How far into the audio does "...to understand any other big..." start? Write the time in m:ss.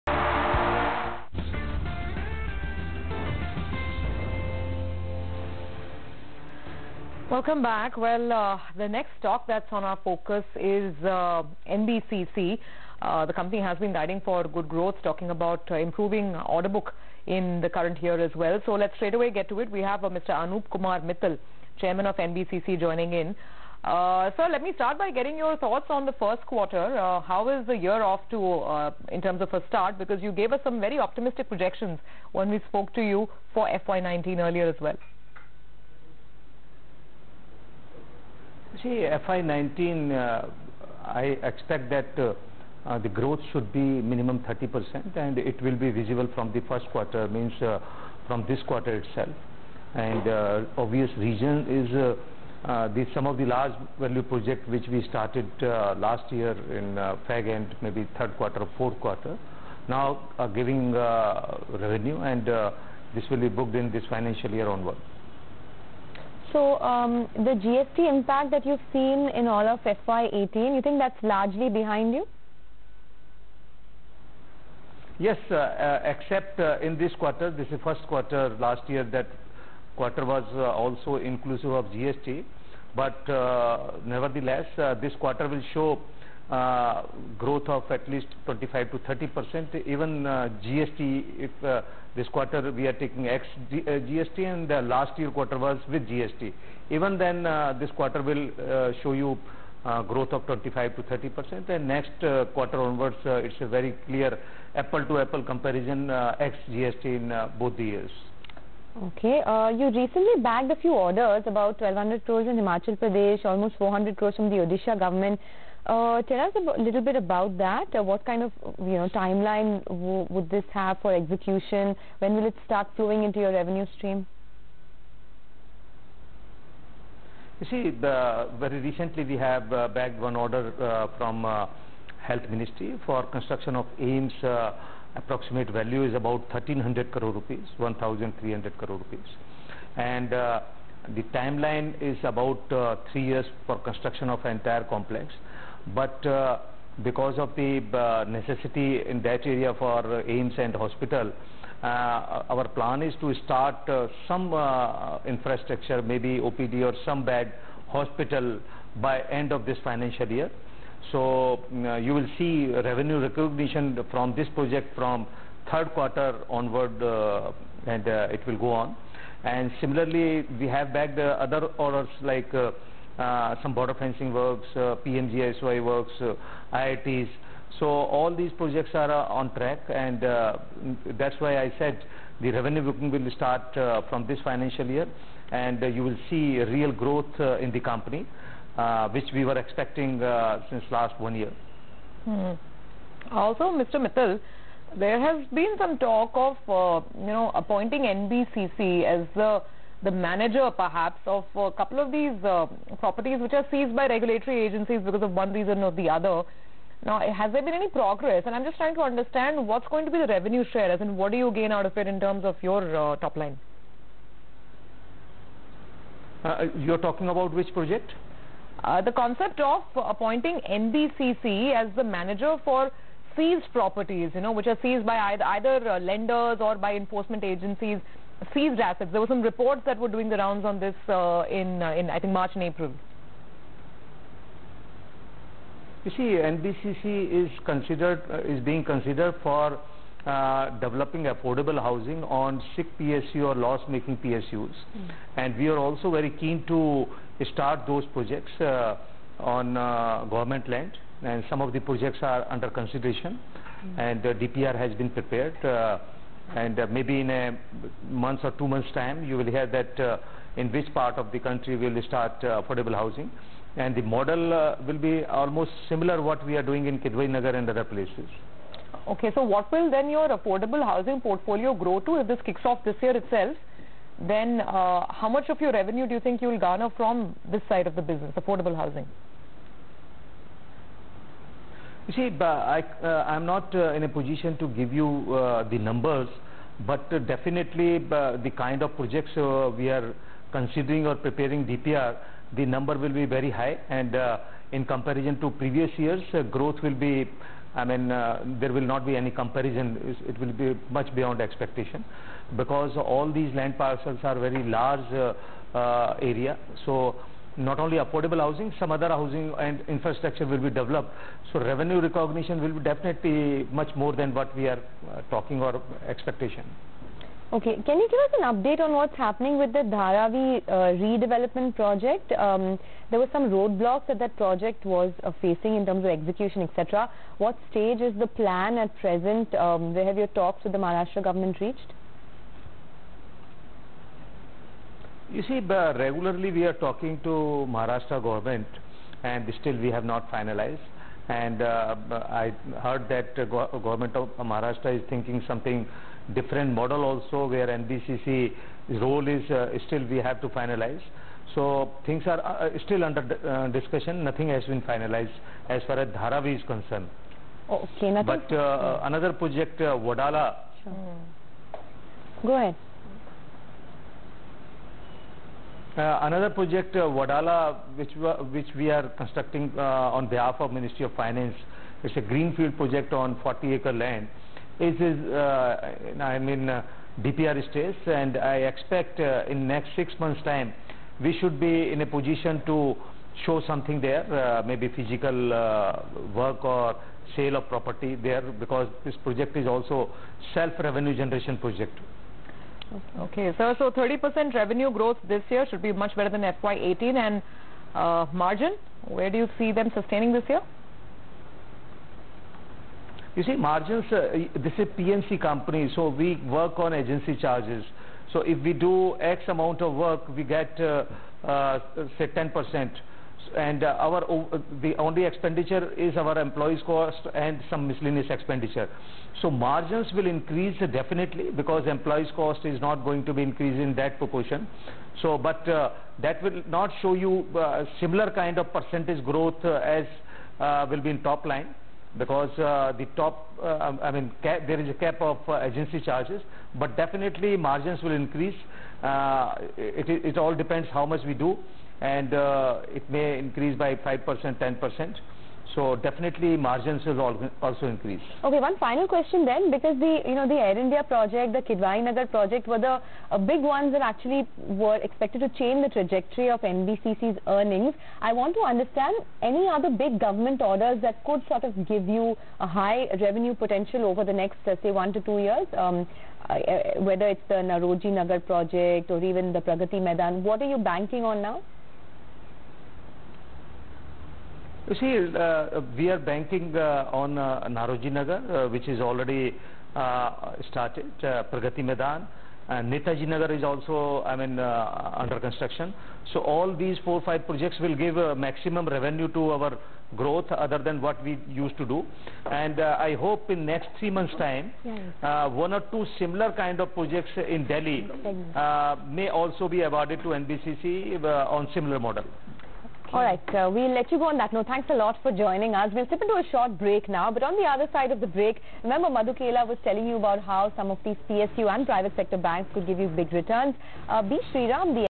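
7:38.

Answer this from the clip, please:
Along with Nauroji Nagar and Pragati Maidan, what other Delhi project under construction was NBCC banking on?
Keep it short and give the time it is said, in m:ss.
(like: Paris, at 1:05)
Netaji Nagar, at 8:02.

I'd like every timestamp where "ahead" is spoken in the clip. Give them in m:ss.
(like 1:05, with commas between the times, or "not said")
6:02.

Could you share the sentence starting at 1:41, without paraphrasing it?
And next quarter onwards, it's a very clear apple to apple comparison ex GST in both the years.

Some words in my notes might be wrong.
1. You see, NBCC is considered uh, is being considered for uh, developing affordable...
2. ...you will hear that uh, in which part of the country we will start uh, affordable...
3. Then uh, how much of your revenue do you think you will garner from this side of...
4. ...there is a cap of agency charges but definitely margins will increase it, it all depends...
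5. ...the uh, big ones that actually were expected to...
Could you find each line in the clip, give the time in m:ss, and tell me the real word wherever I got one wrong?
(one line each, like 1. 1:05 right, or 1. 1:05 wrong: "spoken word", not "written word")
1. 3:56 right
2. 4:19 right
3. 4:34 right
4. 7:14 right
5. 7:32 right.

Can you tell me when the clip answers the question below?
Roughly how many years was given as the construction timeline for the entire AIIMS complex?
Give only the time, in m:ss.
2:23.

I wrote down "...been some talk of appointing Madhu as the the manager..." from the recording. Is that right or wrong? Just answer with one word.
wrong.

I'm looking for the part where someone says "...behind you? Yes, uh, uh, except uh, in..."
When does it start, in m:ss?
1:11.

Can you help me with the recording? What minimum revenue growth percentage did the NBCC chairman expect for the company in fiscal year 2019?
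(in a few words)
30%.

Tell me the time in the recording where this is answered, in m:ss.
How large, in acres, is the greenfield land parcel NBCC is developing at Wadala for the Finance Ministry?
6:13.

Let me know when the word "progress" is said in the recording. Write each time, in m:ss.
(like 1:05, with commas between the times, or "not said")
3:27.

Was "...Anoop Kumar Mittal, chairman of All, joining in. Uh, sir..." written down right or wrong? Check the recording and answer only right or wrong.
wrong.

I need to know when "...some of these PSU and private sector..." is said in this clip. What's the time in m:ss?
8:30.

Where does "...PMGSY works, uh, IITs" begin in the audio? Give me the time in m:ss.
2:55.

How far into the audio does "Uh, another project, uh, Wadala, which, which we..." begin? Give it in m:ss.
6:05.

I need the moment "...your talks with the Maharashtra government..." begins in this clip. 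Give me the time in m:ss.
5:30.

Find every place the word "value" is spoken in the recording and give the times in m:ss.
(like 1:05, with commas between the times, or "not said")
0:53, 2:15.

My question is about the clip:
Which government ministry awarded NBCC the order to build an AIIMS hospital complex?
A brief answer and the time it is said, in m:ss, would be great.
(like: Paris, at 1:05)
Health Ministry, at 2:12.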